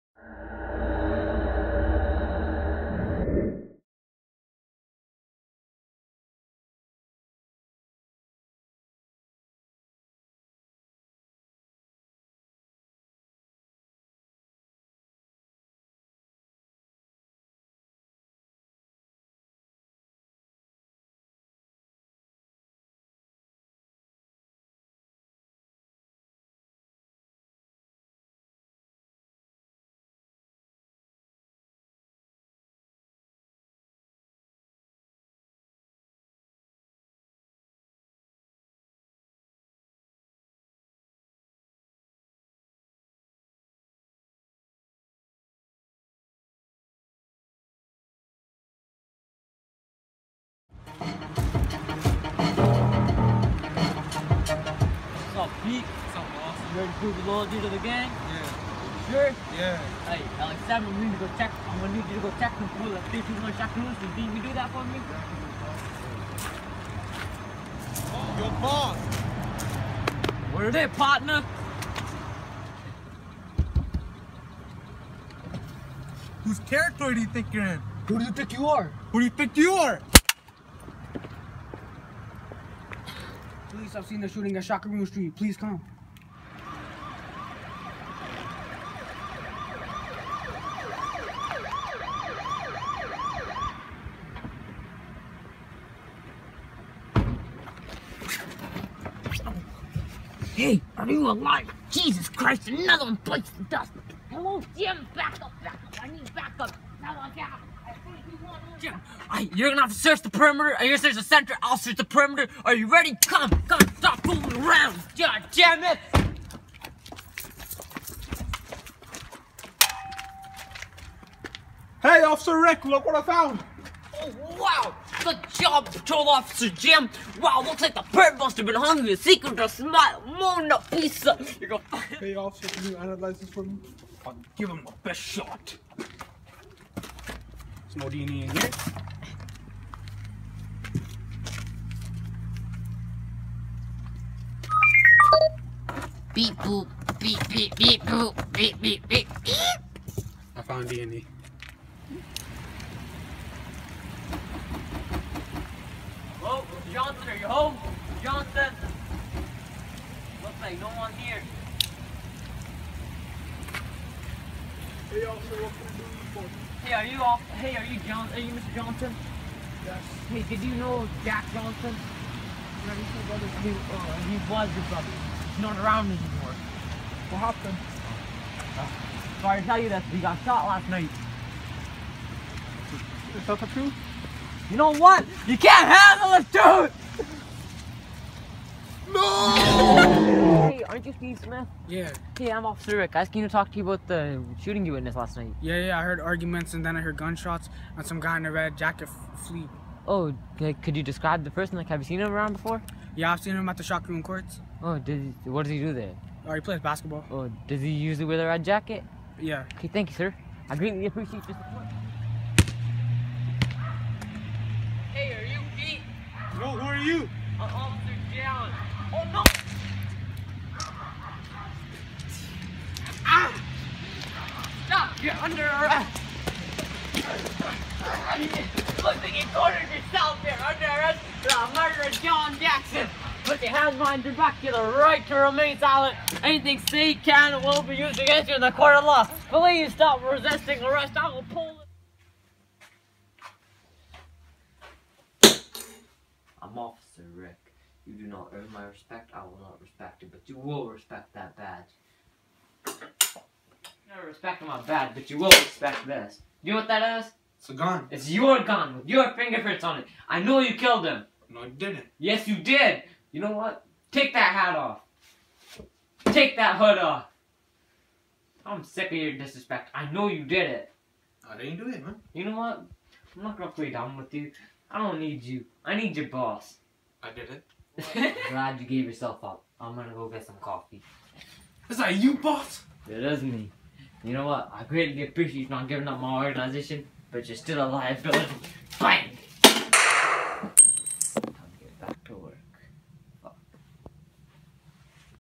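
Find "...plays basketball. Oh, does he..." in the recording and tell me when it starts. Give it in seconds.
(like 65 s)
206 s.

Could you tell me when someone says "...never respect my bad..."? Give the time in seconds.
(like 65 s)
254 s.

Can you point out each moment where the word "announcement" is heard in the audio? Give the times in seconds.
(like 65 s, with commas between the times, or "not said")
not said.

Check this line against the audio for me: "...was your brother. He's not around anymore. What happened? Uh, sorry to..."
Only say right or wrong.
right.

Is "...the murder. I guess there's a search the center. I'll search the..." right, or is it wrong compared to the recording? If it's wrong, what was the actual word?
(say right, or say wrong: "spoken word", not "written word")
wrong: "perimeter", not "murder".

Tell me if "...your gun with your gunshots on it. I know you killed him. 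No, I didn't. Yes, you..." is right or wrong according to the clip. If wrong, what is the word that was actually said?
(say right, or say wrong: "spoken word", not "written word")
wrong: "fingerprints", not "gunshots".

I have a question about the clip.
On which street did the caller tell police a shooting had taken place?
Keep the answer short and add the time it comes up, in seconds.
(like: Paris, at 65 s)
Shakaroon Street, at 84 s.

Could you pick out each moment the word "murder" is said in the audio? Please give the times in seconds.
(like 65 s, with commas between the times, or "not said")
231 s.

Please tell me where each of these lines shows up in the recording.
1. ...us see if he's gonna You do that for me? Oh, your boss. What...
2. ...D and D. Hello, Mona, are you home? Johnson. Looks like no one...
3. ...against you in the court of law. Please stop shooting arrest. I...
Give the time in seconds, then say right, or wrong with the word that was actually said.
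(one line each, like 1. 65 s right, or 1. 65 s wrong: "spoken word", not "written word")
1. 63 s right
2. 150 s wrong: "Johnson", not "Mona"
3. 238 s wrong: "resisting", not "shooting".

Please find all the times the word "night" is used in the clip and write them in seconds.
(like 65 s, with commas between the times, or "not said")
180 s, 195 s.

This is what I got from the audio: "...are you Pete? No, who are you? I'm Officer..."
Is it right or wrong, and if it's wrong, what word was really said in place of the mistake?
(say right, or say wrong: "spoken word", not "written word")
right.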